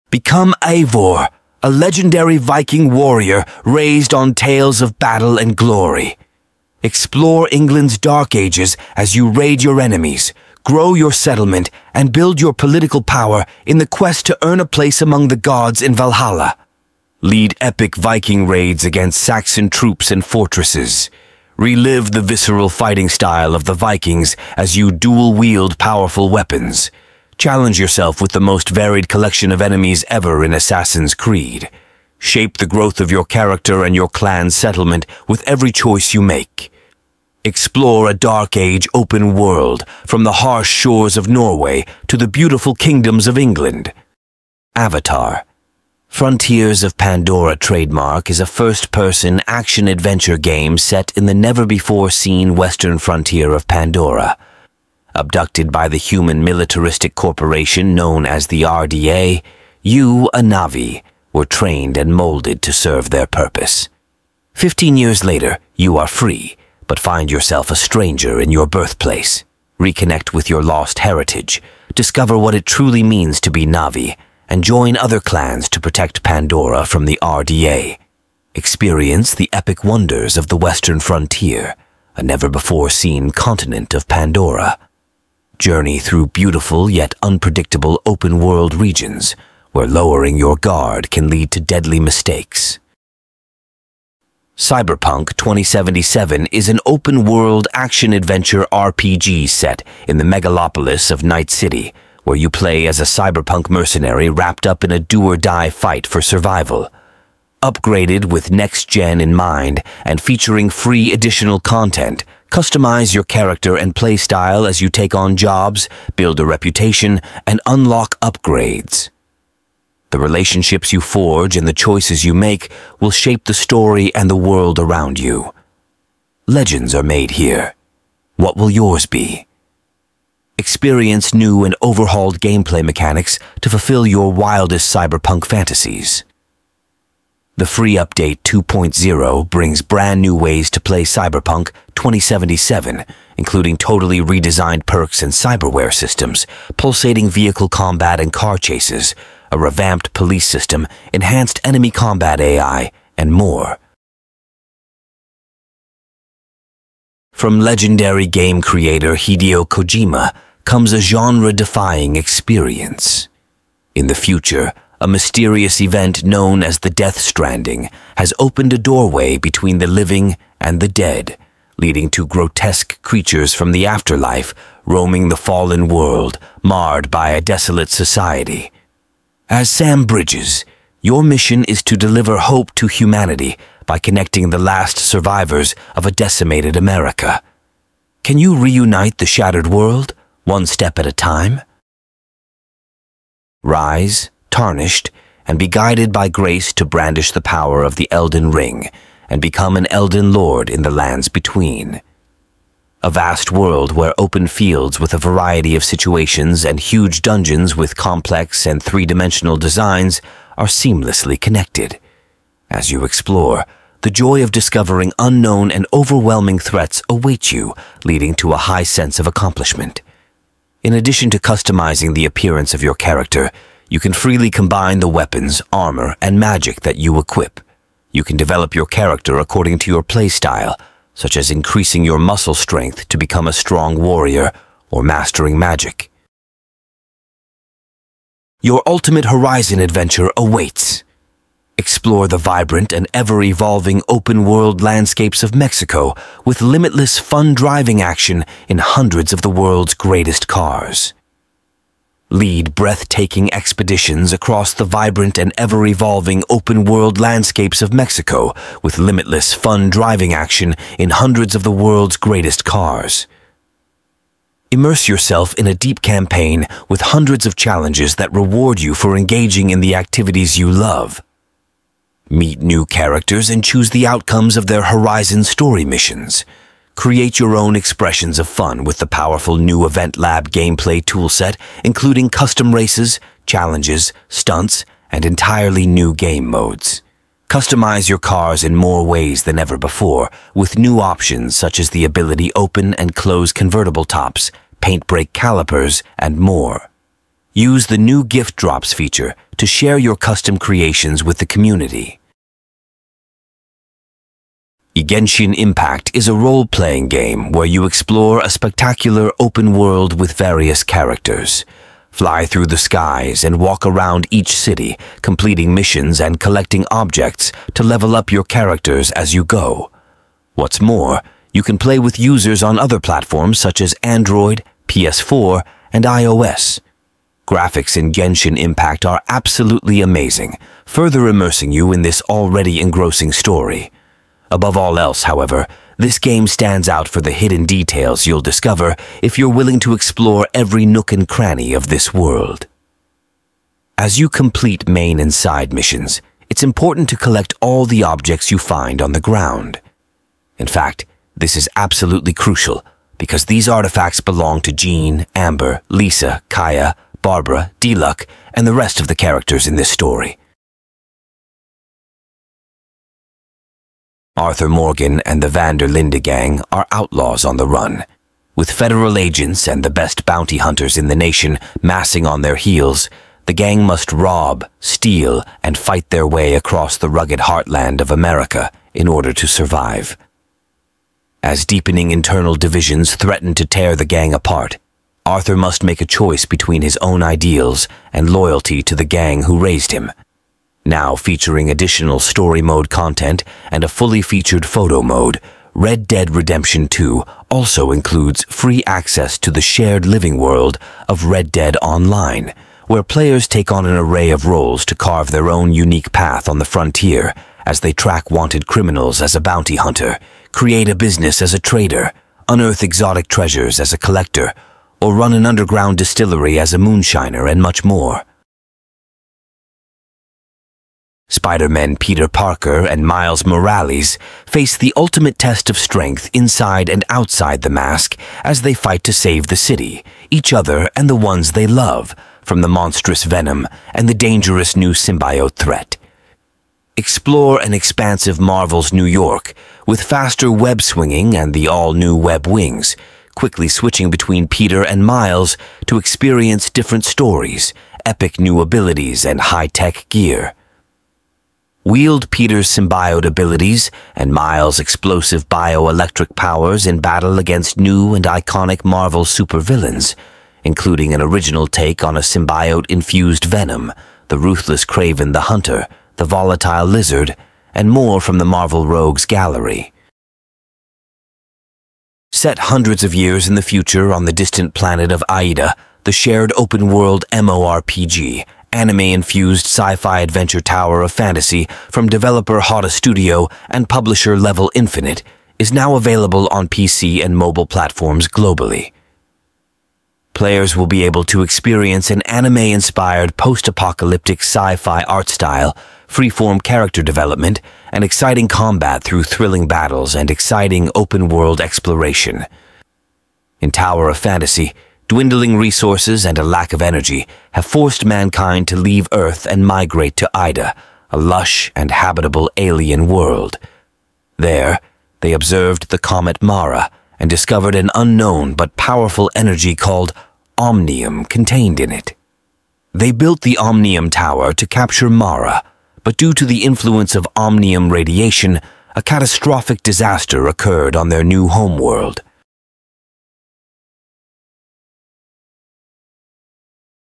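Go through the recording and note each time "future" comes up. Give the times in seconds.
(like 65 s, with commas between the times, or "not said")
164 s, 473 s.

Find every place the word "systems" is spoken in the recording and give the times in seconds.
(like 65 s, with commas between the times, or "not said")
145 s, 150 s.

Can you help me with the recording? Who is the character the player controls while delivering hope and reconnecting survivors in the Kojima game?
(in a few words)
Sam Bridges.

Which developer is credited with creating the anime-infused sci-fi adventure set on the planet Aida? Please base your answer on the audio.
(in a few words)
Hotta Studio.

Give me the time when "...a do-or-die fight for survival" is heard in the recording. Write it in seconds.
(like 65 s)
104 s.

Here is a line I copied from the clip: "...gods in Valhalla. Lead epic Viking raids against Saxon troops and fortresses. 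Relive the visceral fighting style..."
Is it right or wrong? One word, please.
right.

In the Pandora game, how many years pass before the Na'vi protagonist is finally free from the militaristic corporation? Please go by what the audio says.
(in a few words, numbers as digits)
15.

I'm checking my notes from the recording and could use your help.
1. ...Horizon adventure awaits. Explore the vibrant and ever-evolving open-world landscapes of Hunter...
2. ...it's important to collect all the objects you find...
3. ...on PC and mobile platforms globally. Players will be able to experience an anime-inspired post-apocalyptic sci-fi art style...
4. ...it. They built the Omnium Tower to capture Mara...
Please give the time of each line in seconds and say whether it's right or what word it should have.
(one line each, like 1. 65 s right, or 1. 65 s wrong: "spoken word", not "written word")
1. 239 s wrong: "Mexico", not "Hunter"
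2. 346 s right
3. 486 s right
4. 521 s right.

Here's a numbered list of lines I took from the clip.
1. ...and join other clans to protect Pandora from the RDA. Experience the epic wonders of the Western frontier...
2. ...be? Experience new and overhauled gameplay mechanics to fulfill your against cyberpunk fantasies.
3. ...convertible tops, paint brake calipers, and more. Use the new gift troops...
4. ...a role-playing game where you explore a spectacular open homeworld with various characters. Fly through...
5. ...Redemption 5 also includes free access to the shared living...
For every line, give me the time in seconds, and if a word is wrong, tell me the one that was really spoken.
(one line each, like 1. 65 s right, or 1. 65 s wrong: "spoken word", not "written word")
1. 74 s right
2. 129 s wrong: "wildest", not "against"
3. 293 s wrong: "drops", not "troops"
4. 306 s wrong: "world", not "homeworld"
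5. 396 s wrong: "2", not "5".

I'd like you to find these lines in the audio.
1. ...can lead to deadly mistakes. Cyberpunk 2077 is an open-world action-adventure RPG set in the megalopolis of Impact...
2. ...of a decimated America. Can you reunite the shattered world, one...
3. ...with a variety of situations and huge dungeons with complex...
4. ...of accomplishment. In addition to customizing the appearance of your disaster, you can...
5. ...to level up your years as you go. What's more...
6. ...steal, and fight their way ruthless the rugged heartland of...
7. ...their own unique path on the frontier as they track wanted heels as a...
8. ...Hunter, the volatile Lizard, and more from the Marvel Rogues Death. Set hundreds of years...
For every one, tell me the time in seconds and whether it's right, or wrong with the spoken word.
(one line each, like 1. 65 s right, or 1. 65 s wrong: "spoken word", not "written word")
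1. 91 s wrong: "Night", not "Impact"
2. 185 s right
3. 204 s right
4. 219 s wrong: "character", not "disaster"
5. 317 s wrong: "characters", not "years"
6. 374 s wrong: "across", not "ruthless"
7. 405 s wrong: "criminals", not "heels"
8. 465 s wrong: "Gallery", not "Death".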